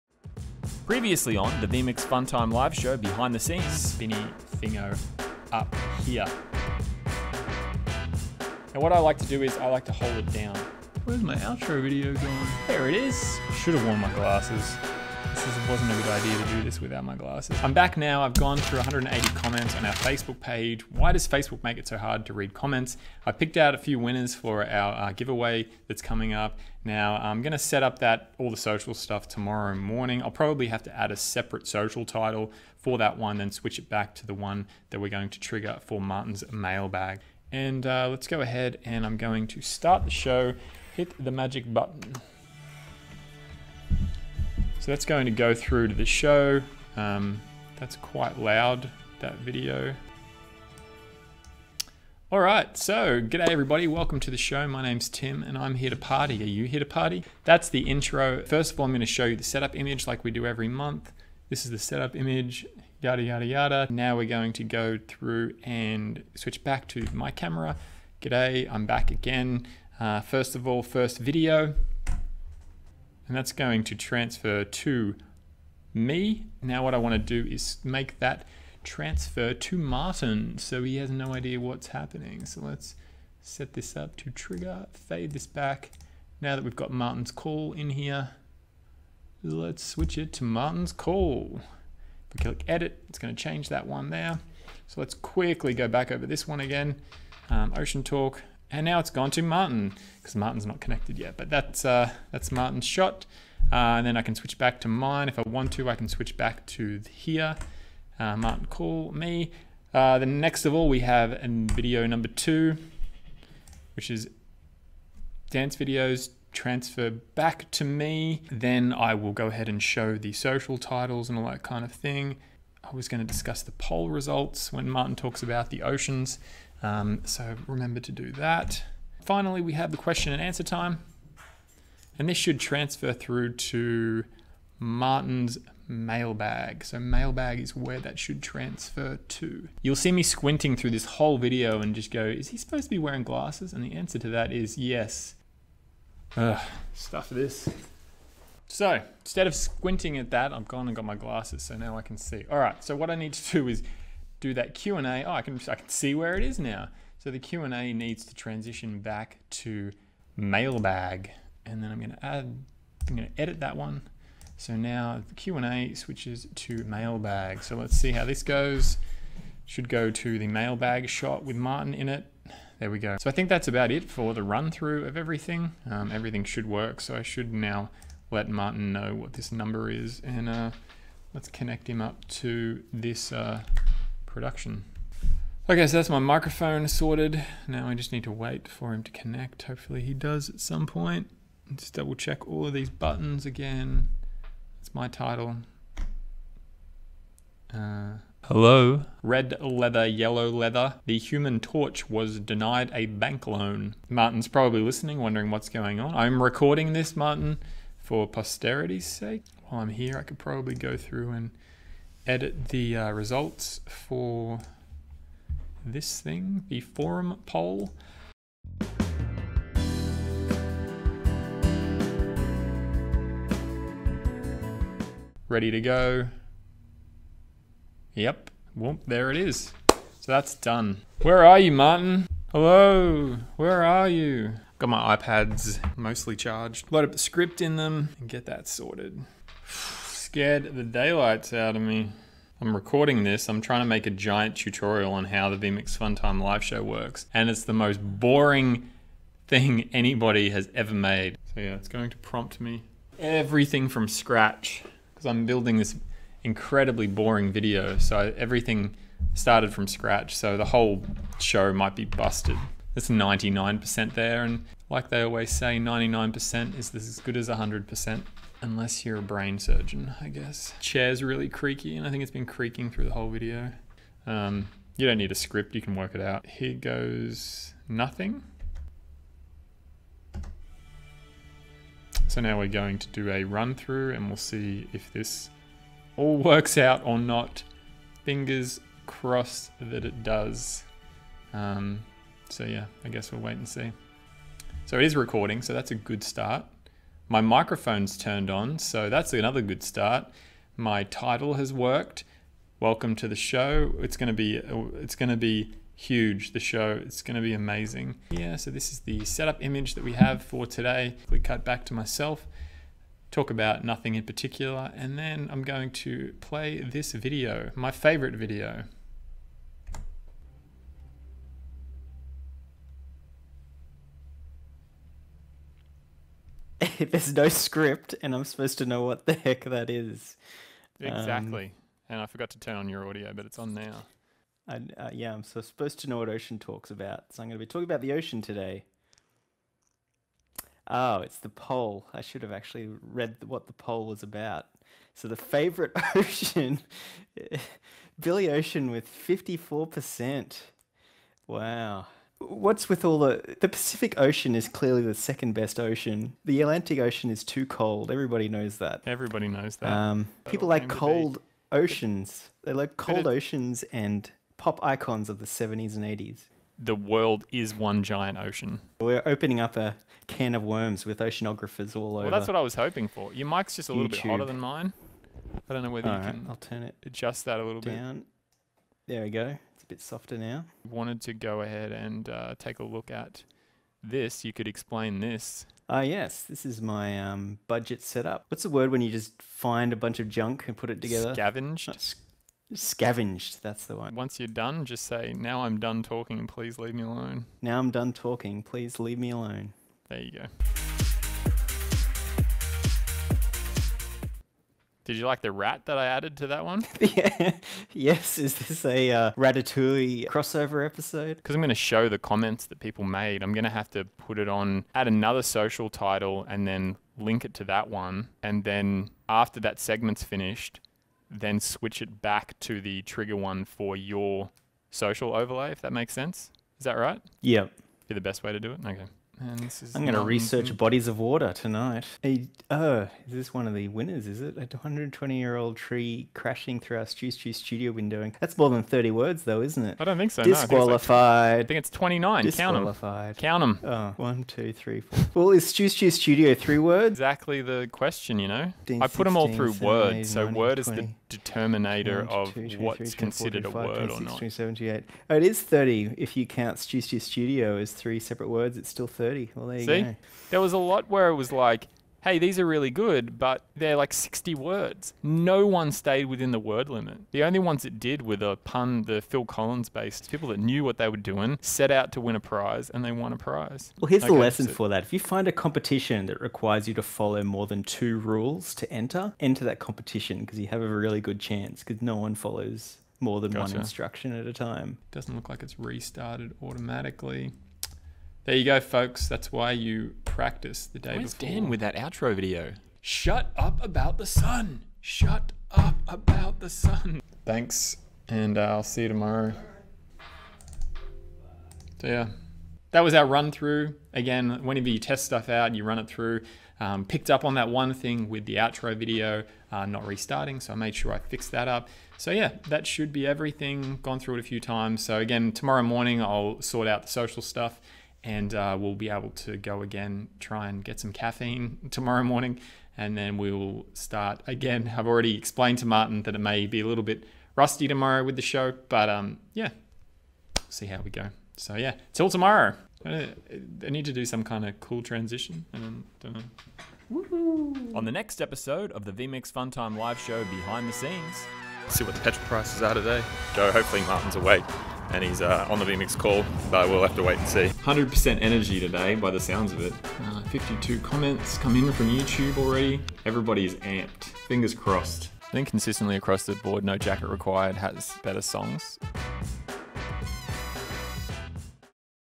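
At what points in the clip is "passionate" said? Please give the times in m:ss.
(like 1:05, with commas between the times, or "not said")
not said.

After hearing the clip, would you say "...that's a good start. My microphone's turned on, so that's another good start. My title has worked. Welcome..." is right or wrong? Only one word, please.
right.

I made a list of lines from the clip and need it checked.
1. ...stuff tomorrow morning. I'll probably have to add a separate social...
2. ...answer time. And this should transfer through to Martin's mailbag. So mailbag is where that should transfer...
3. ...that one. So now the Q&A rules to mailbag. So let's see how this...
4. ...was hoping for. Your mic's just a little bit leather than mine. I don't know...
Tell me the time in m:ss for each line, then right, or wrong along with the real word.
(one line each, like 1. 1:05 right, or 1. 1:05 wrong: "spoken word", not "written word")
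1. 0:28 right
2. 2:10 right
3. 2:43 wrong: "switches", not "rules"
4. 6:12 wrong: "hotter", not "leather".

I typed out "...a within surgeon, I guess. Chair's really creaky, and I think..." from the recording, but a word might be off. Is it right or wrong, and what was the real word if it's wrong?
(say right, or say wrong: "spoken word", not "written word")
wrong: "brain", not "within".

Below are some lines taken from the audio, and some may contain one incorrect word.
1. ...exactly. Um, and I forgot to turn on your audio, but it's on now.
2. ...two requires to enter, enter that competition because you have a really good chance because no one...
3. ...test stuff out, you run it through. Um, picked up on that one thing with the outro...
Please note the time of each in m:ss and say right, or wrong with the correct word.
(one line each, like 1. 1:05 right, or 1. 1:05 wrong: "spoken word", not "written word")
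1. 5:31 right
2. 7:57 wrong: "rules", not "requires"
3. 8:24 right.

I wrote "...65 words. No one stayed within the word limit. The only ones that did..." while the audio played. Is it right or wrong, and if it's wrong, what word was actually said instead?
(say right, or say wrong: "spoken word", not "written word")
wrong: "60", not "65".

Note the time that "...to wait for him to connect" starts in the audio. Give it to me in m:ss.
3:08.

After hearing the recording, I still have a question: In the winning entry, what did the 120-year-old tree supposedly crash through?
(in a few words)
studio window.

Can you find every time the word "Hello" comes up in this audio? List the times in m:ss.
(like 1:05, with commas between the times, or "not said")
3:18, 3:52.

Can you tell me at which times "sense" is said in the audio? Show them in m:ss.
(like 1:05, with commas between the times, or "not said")
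7:06.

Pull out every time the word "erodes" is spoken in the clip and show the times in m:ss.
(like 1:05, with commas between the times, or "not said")
not said.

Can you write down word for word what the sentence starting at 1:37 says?
Um, Ocean Talk, and now it's gone to Martin because Martin's not connected yet.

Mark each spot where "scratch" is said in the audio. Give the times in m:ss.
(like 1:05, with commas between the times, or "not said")
4:14, 4:19.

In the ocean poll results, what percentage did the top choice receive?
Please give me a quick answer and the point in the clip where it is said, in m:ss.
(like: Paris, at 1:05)
54%, at 5:49.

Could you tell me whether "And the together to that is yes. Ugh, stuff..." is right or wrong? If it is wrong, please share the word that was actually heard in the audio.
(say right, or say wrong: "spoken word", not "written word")
wrong: "answer", not "together".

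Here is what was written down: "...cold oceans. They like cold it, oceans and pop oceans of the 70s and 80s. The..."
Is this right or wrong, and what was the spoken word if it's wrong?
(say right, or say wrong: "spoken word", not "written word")
wrong: "icons", not "oceans".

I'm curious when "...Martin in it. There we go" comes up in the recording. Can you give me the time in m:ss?
2:51.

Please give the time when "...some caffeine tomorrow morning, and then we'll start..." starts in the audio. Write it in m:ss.
8:40.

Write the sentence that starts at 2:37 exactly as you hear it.
So the Q&A needs to transition back to mailbag.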